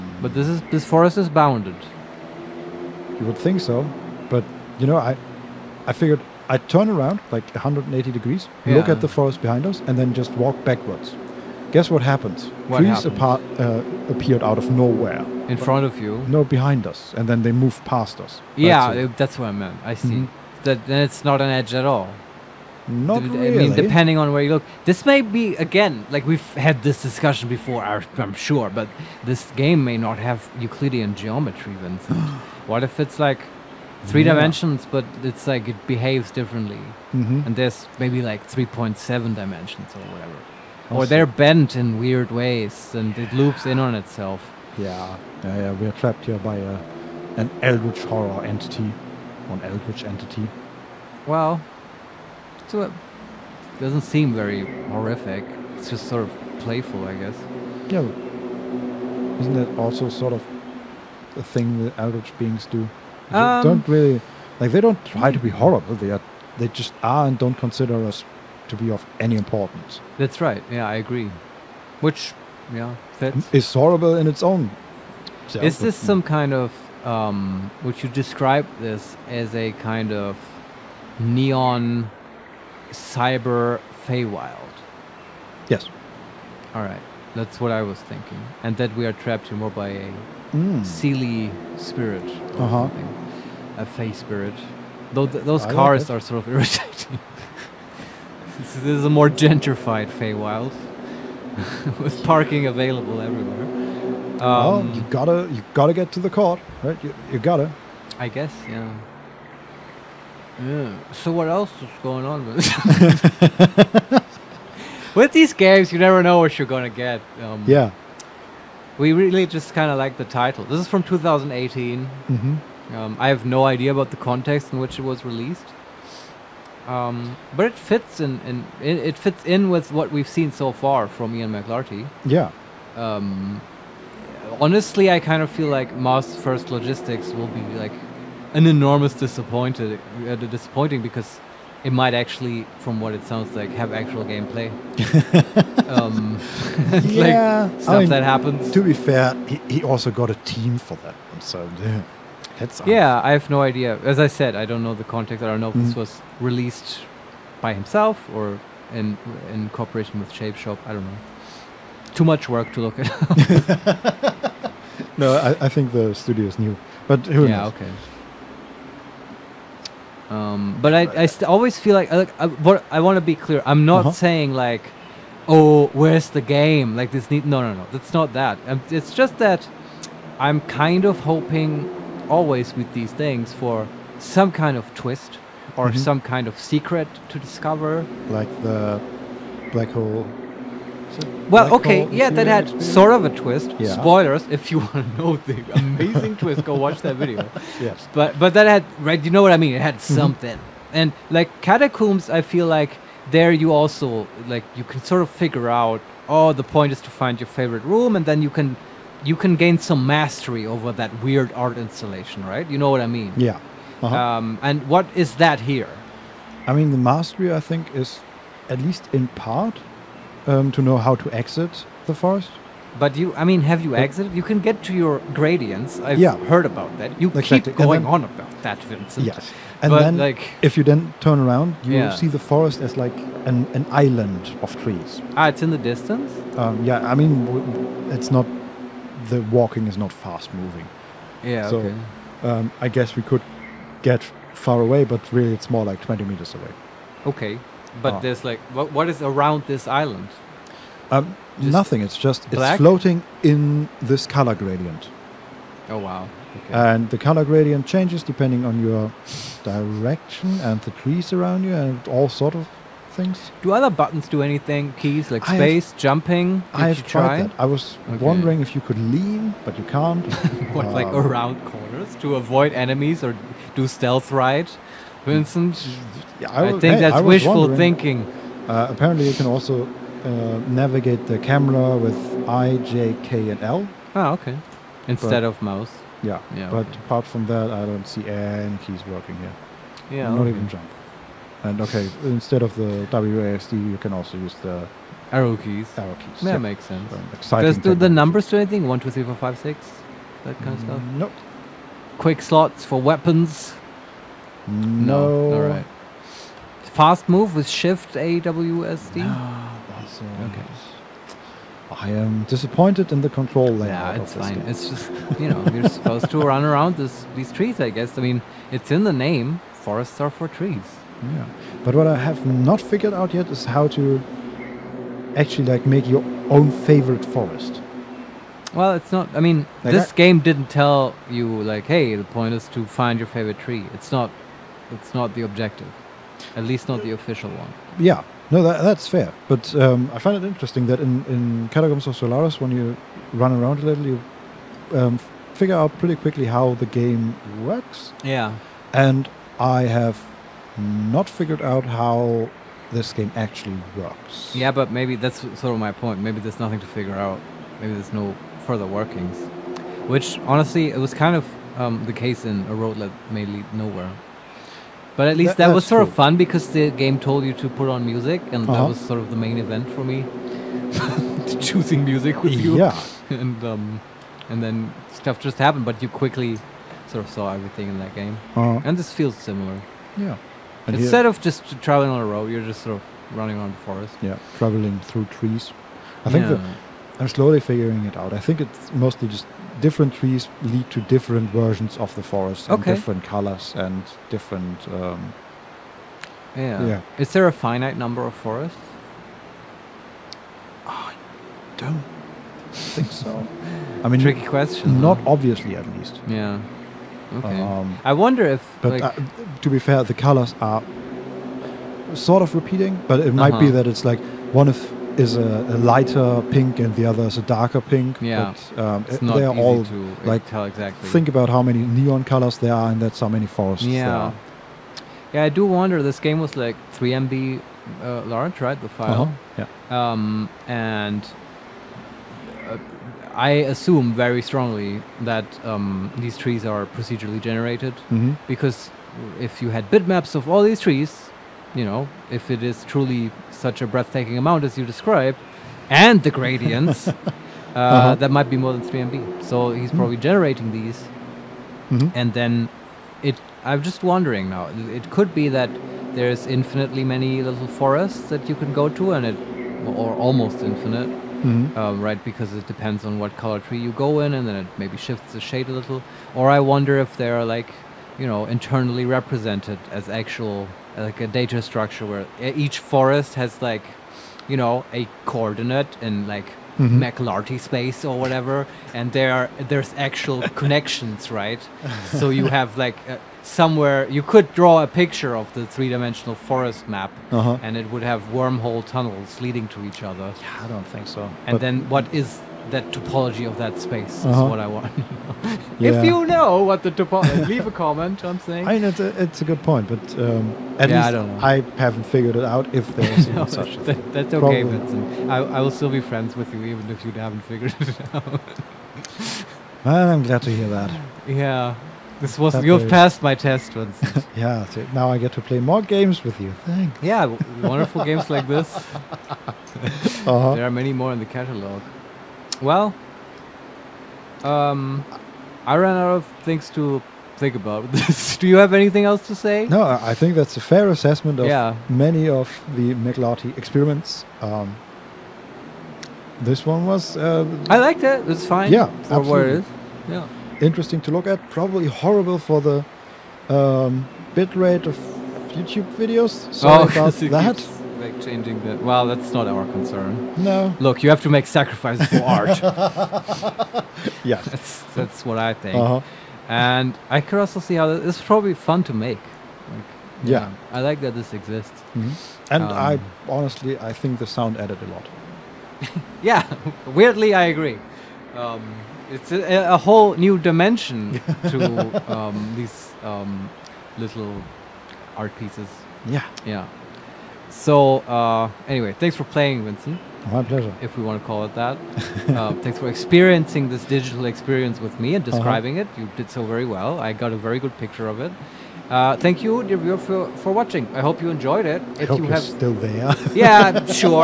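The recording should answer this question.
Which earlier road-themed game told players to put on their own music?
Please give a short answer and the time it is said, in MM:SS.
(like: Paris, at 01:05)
A Road That May Lead Nowhere, at 06:02.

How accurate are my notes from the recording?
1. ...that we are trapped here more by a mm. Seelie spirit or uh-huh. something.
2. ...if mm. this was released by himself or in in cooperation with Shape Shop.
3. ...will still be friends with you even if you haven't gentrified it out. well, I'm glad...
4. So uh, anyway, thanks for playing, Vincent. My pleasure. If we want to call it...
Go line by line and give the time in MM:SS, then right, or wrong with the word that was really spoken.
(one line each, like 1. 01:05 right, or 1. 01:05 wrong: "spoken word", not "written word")
1. 01:28 right
2. 02:35 right
3. 08:25 wrong: "figured", not "gentrified"
4. 09:37 right.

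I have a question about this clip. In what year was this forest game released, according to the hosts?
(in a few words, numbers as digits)
2018.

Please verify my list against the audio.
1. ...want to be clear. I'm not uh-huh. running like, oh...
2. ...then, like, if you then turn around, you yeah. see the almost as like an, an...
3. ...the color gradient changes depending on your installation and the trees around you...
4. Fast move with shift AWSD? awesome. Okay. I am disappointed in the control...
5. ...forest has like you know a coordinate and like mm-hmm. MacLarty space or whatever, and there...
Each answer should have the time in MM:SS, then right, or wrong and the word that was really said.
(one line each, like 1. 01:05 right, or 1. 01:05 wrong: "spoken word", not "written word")
1. 02:52 wrong: "saying", not "running"
2. 03:49 wrong: "forest", not "almost"
3. 04:17 wrong: "direction", not "installation"
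4. 05:06 right
5. 07:52 right.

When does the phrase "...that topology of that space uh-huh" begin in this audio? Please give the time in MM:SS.
08:12.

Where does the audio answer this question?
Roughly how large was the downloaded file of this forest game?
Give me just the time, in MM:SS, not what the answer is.
07:06.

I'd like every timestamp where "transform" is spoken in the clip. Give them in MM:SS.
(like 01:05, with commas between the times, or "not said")
not said.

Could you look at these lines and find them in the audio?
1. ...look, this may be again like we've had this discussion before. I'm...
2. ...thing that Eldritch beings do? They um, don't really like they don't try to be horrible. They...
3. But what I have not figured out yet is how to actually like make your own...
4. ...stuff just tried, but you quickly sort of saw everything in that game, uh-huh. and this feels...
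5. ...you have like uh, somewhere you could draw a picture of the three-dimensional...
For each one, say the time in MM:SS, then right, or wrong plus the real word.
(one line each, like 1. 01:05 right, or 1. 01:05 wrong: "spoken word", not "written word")
1. 00:24 right
2. 01:01 right
3. 05:21 right
4. 06:15 wrong: "happened", not "tried"
5. 08:02 right.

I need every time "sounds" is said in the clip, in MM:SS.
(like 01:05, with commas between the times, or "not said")
02:23, 09:24.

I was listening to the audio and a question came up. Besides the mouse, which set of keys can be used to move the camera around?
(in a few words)
I, J, K, and L.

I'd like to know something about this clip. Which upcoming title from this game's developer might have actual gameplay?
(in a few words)
Mars First Logistics.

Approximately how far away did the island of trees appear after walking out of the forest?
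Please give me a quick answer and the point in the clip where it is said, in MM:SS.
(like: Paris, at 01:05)
20 meters, at 04:05.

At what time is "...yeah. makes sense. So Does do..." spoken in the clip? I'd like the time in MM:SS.
04:56.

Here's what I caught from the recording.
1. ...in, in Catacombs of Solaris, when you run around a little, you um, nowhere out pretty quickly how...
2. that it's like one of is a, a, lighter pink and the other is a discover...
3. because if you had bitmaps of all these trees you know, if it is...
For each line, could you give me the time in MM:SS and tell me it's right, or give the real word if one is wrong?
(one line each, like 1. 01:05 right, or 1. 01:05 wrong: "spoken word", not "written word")
1. 05:40 wrong: "figure", not "nowhere"
2. 06:53 wrong: "darker", not "discover"
3. 07:18 right.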